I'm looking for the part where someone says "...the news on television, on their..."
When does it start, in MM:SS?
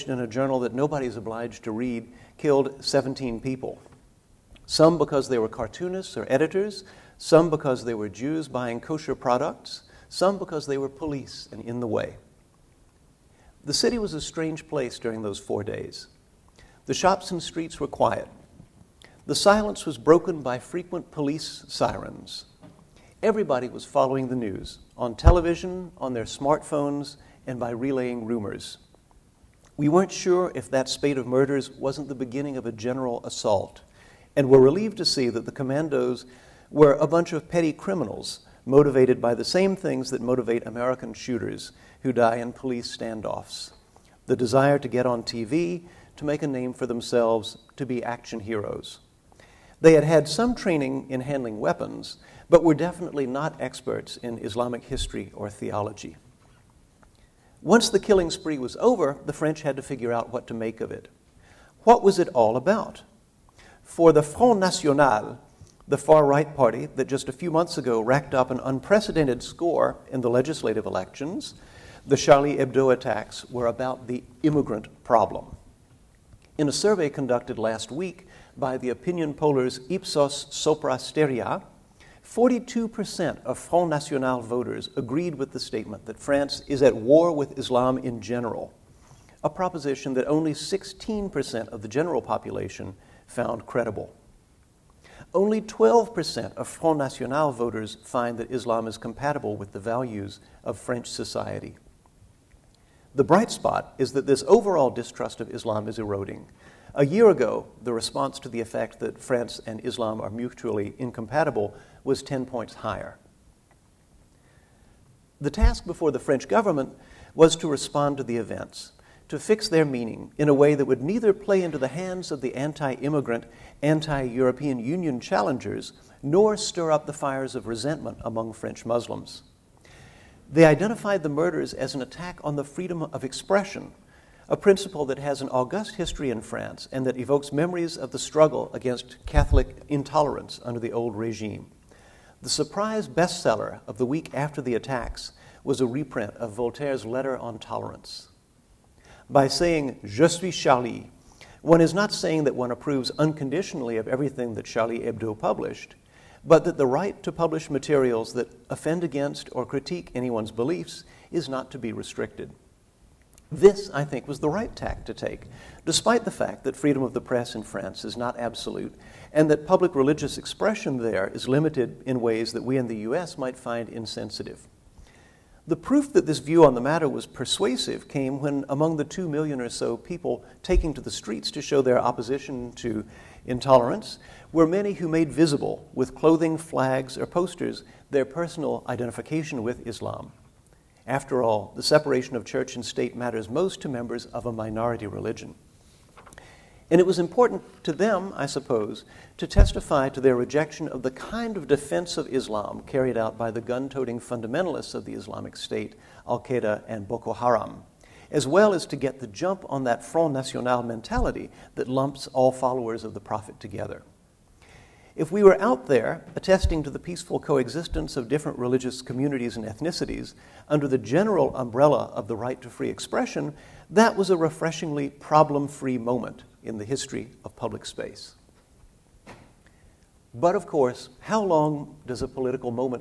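00:24.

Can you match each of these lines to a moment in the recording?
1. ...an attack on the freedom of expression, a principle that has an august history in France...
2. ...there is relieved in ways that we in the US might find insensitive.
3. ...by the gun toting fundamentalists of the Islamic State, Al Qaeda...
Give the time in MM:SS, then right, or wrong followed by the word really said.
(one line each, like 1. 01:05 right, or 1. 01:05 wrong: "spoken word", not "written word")
1. 02:11 right
2. 02:50 wrong: "limited", not "relieved"
3. 03:23 right.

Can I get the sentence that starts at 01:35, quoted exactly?
Only 12% of Front National voters find that Islam is compatible with the values of French society.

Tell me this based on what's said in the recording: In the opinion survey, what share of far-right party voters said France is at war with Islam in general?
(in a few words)
42%.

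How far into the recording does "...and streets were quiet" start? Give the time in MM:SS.
00:17.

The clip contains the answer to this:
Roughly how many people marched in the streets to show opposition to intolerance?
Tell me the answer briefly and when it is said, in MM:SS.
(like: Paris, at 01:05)
2 million, at 02:59.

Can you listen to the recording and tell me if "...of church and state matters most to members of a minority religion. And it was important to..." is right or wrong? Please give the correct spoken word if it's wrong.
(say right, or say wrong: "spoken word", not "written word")
right.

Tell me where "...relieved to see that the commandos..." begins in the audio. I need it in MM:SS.
00:34.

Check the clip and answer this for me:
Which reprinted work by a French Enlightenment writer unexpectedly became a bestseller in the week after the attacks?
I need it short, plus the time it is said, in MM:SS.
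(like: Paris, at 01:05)
Letter on tolerance, at 02:27.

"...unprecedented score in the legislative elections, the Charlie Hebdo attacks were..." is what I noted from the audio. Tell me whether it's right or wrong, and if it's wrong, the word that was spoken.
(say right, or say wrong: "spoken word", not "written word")
right.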